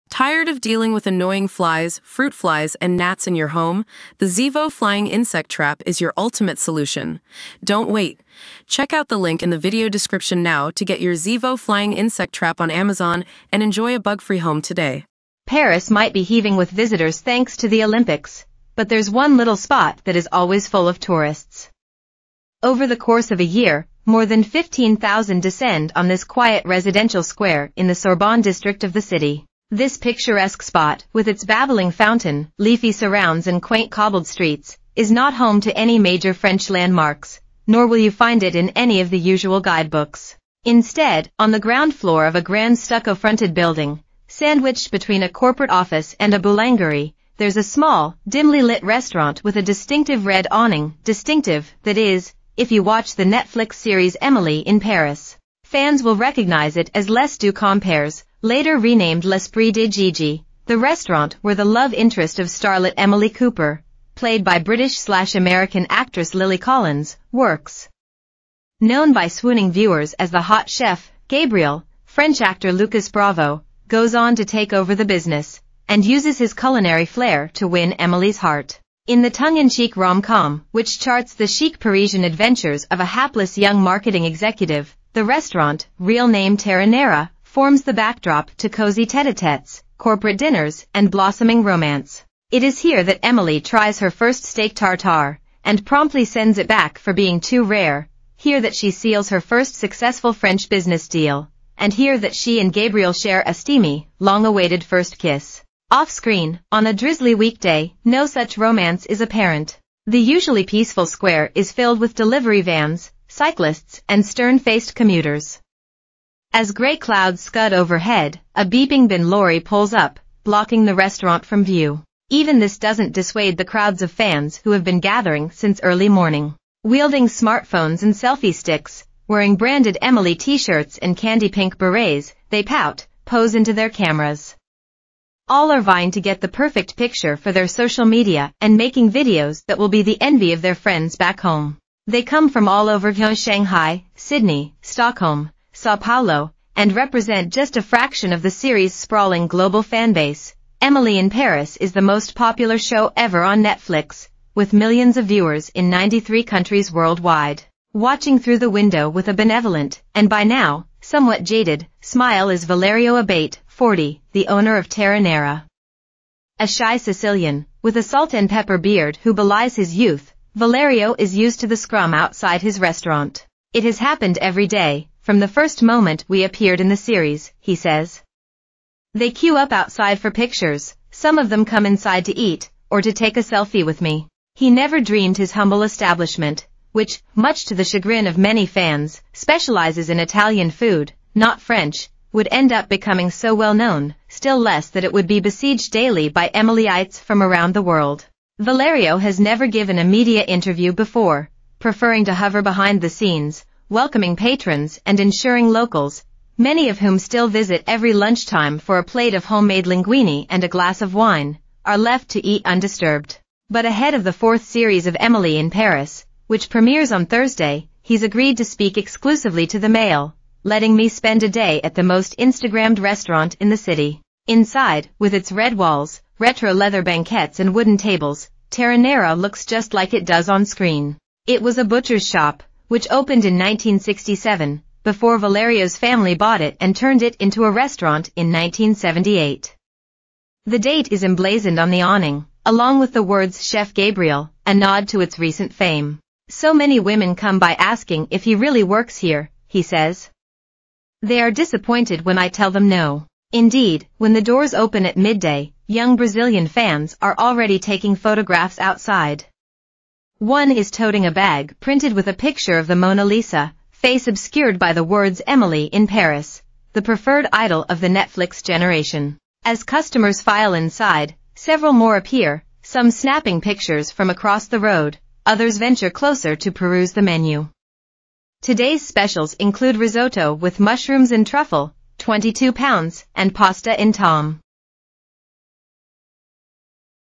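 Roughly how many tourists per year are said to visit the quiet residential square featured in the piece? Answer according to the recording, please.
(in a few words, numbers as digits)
15,000.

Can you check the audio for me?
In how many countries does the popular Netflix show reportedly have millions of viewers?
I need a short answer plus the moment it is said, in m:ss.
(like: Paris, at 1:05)
93, at 2:35.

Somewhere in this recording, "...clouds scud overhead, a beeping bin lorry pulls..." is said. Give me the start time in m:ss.
1:56.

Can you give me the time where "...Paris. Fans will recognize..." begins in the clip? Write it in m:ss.
0:54.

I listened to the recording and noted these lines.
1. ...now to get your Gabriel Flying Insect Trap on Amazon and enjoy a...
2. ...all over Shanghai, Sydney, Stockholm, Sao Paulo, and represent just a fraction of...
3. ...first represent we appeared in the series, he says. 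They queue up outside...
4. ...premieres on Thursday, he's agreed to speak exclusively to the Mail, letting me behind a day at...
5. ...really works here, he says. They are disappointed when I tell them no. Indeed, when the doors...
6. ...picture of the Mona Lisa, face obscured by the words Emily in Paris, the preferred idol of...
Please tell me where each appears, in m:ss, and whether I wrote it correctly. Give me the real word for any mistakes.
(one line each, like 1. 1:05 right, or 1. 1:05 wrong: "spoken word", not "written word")
1. 0:10 wrong: "Zevo", not "Gabriel"
2. 2:22 right
3. 2:55 wrong: "moment", not "represent"
4. 3:36 wrong: "spend", not "behind"
5. 4:08 right
6. 4:22 right.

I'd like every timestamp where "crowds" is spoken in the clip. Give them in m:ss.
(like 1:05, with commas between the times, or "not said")
2:03.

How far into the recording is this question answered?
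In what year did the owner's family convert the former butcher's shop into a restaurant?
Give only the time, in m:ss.
3:58.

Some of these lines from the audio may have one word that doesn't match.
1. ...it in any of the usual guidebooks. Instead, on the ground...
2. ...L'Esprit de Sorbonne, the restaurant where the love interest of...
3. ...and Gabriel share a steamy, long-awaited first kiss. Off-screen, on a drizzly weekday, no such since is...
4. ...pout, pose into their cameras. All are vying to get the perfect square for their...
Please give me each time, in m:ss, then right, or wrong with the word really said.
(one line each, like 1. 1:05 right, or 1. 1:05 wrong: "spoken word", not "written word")
1. 0:38 right
2. 0:59 wrong: "Gigi", not "Sorbonne"
3. 1:42 wrong: "romance", not "since"
4. 2:12 wrong: "picture", not "square".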